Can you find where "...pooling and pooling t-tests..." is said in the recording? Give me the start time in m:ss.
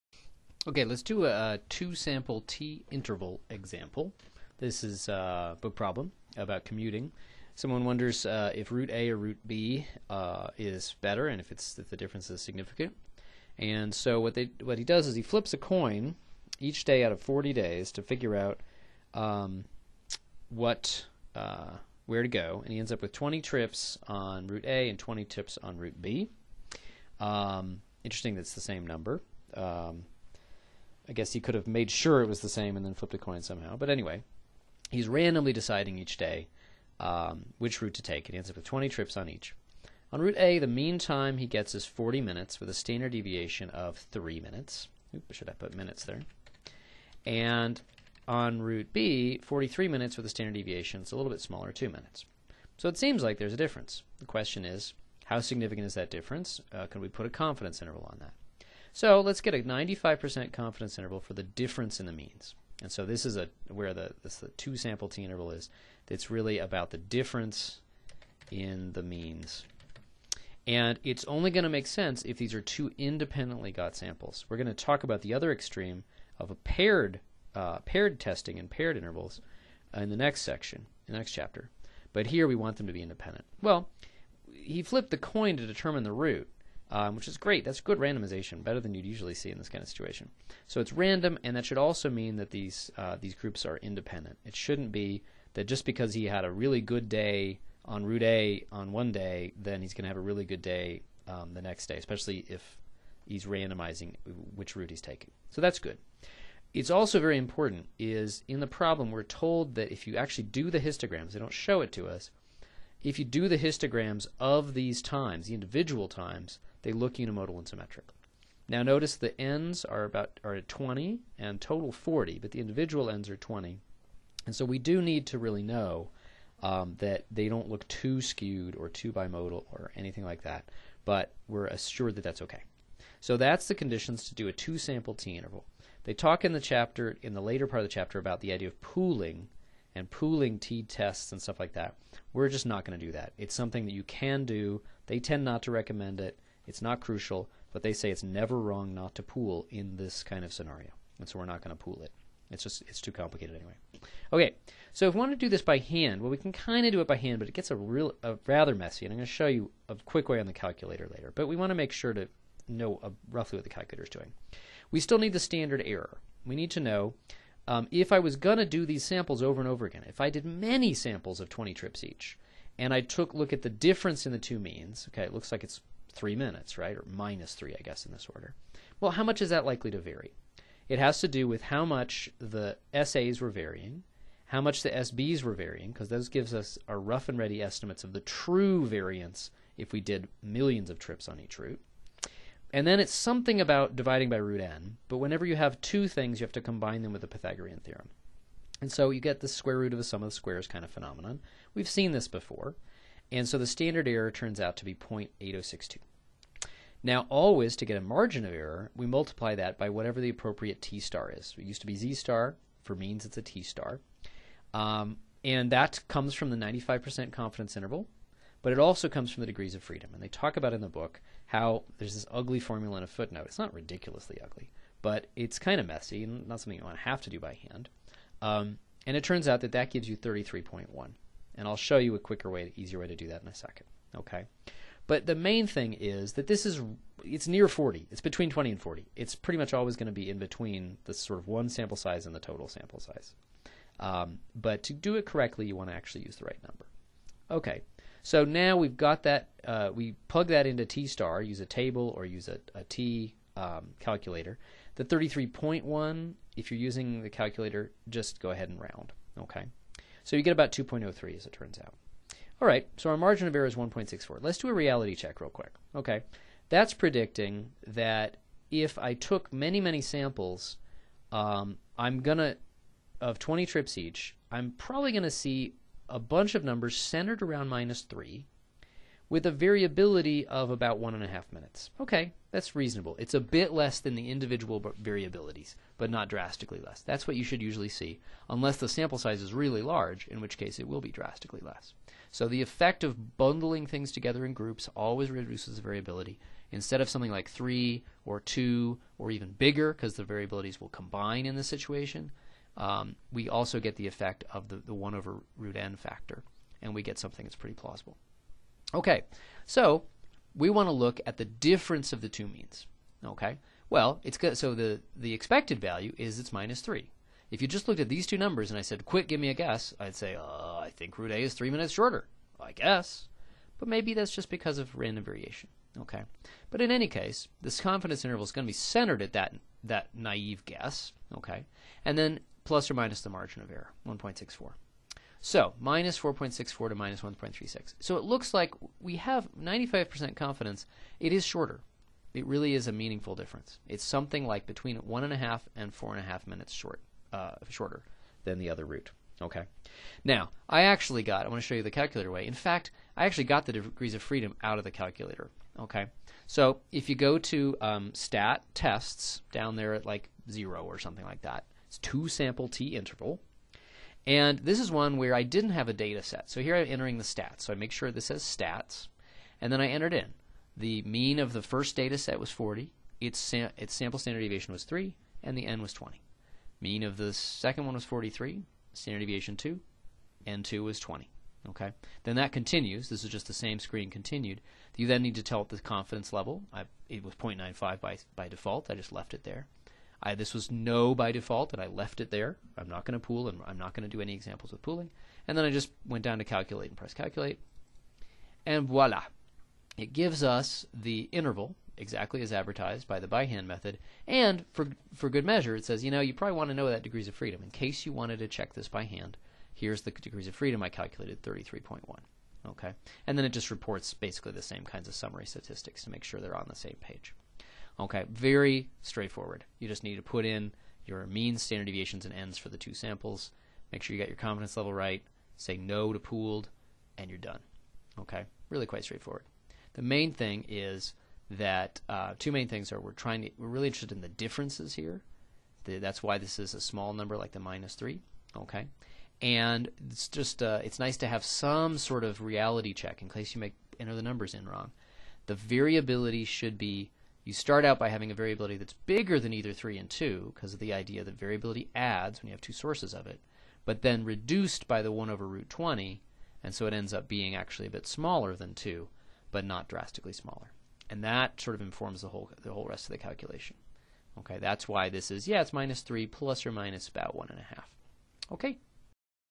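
2:18.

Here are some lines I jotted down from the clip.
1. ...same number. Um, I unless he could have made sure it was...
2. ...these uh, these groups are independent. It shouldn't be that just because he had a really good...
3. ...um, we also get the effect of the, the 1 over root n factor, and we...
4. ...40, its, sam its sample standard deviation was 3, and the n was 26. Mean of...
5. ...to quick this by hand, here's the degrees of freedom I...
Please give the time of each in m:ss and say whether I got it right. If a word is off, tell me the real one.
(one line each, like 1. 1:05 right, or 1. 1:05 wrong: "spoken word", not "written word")
1. 0:28 wrong: "guess", not "unless"
2. 1:32 right
3. 5:02 right
4. 6:12 wrong: "20", not "26"
5. 6:48 wrong: "check", not "quick".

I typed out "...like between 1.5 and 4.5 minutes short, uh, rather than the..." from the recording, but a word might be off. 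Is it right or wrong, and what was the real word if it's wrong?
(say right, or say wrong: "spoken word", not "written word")
wrong: "shorter", not "rather".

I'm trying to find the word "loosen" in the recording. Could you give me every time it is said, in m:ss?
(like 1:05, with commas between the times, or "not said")
not said.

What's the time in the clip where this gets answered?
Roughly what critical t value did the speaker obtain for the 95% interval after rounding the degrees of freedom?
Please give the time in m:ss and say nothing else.
4:20.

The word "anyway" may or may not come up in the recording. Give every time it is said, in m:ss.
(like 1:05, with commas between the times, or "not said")
0:33, 2:33.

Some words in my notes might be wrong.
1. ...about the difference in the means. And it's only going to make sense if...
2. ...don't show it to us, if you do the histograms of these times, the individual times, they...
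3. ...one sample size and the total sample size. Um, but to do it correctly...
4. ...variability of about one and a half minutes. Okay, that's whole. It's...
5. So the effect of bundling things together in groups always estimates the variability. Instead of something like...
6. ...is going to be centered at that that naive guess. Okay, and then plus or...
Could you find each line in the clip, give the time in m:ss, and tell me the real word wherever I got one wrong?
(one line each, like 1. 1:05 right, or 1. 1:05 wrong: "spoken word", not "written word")
1. 1:06 right
2. 1:51 right
3. 4:01 right
4. 4:39 wrong: "reasonable", not "whole"
5. 4:52 wrong: "reduces", not "estimates"
6. 5:28 right.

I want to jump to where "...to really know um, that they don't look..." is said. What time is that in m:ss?
2:05.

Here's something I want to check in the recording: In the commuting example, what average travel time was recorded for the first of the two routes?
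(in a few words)
40 minutes.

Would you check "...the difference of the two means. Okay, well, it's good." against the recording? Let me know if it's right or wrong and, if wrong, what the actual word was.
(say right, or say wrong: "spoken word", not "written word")
right.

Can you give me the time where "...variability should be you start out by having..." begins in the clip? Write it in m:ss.
7:25.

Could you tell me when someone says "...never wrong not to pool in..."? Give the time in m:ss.
2:28.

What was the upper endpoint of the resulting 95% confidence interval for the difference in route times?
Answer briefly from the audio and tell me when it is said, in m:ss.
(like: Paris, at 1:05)
-1.36, at 5:36.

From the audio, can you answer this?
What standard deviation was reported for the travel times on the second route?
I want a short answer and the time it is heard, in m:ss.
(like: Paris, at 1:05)
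2 minutes, at 0:51.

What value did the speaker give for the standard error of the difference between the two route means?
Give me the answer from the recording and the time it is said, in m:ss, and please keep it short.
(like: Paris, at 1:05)
0.8062, at 3:24.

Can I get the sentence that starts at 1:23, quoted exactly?
Well, he flipped the coin to determine the route um, which is great.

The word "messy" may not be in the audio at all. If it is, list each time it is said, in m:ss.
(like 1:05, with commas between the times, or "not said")
2:38, 3:45.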